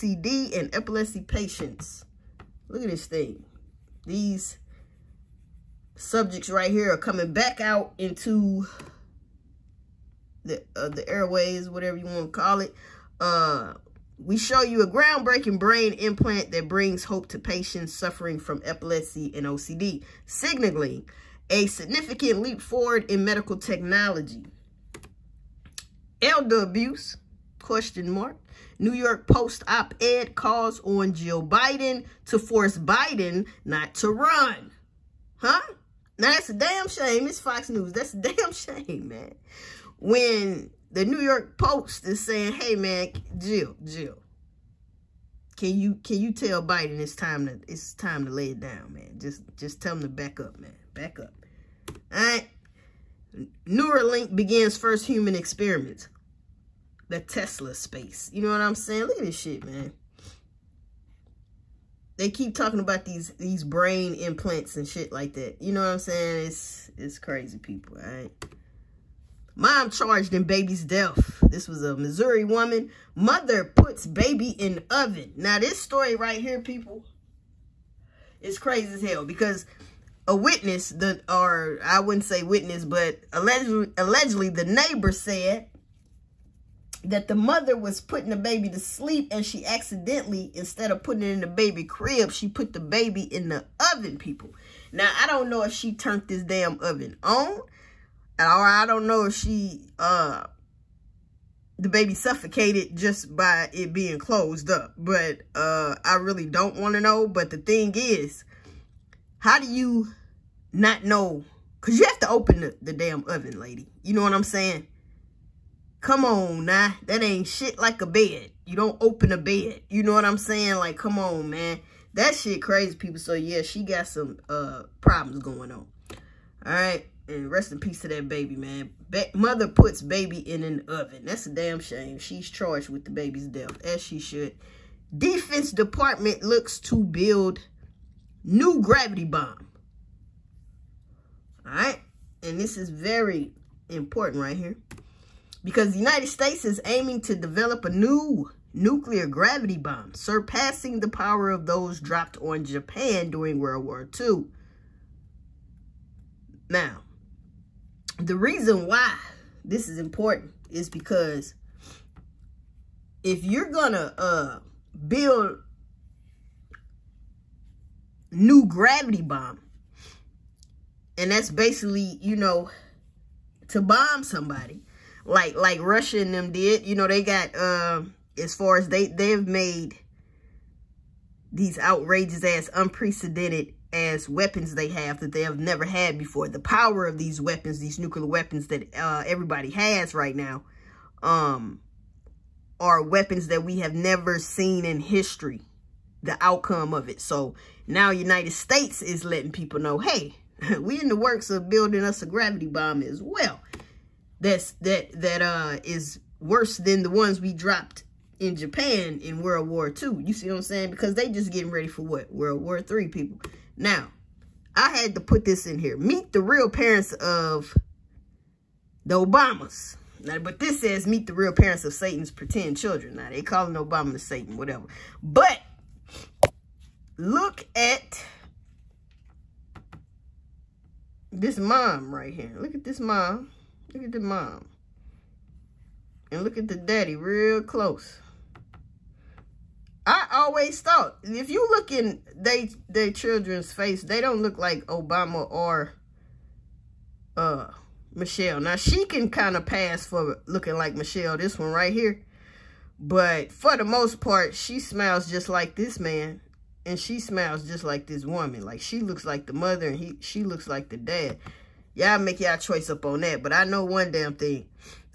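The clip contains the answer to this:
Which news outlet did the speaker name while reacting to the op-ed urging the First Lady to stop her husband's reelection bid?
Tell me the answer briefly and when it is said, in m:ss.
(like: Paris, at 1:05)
Fox News, at 0:37.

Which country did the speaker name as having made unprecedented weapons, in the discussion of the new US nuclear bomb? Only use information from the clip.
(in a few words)
Russia.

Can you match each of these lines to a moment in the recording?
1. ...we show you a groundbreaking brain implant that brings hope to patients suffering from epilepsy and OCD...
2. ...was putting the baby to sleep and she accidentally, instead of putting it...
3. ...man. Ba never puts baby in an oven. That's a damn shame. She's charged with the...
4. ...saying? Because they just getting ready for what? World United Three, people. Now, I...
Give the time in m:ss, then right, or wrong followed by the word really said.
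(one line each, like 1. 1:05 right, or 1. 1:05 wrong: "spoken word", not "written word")
1. 0:14 right
2. 1:27 right
3. 2:08 wrong: "mother", not "never"
4. 3:30 wrong: "War", not "United".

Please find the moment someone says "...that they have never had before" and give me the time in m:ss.
3:05.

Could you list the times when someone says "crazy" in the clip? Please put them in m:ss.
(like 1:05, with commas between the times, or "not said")
1:07, 1:18, 2:02.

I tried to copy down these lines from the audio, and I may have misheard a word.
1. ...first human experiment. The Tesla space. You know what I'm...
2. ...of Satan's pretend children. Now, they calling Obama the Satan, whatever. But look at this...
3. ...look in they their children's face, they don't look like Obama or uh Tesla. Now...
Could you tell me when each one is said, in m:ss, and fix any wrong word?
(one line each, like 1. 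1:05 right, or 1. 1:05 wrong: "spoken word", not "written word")
1. 0:54 right
2. 3:41 right
3. 4:01 wrong: "Michelle", not "Tesla".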